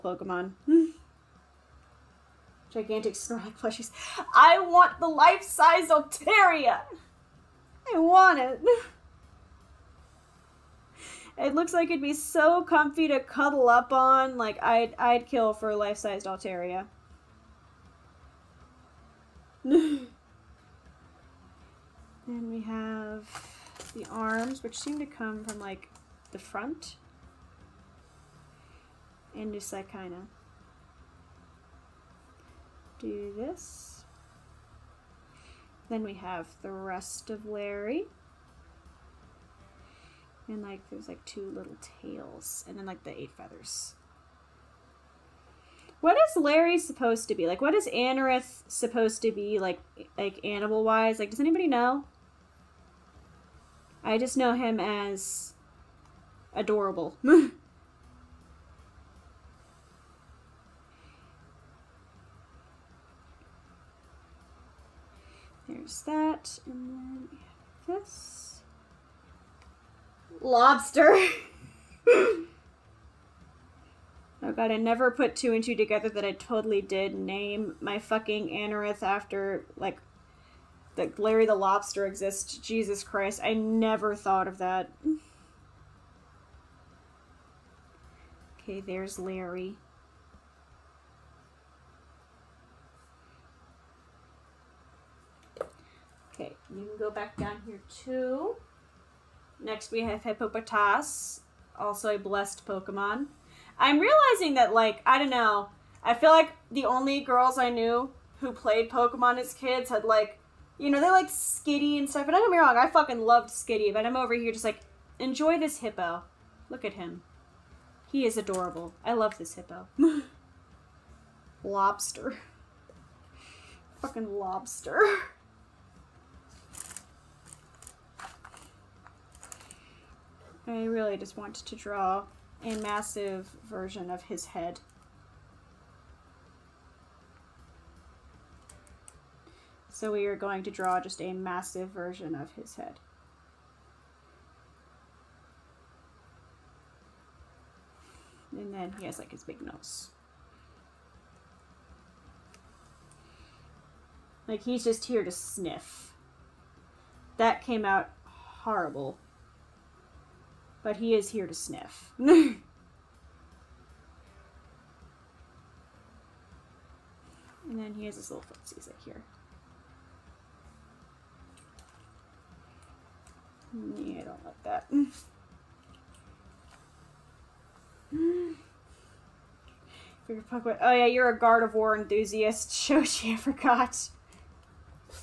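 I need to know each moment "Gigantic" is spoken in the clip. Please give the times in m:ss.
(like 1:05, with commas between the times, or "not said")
0:02.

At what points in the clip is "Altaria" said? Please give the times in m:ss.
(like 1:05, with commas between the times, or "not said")
0:05, 0:16.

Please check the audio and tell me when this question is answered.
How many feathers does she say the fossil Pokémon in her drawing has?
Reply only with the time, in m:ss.
0:43.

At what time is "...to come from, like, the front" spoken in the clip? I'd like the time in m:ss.
0:24.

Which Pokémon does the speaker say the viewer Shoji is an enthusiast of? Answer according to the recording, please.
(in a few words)
Gardevoir.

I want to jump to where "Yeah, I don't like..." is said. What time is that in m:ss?
2:53.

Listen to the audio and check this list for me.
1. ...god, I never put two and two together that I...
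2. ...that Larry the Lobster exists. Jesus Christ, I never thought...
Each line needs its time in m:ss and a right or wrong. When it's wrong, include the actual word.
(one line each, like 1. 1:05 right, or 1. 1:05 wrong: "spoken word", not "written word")
1. 1:14 right
2. 1:20 right.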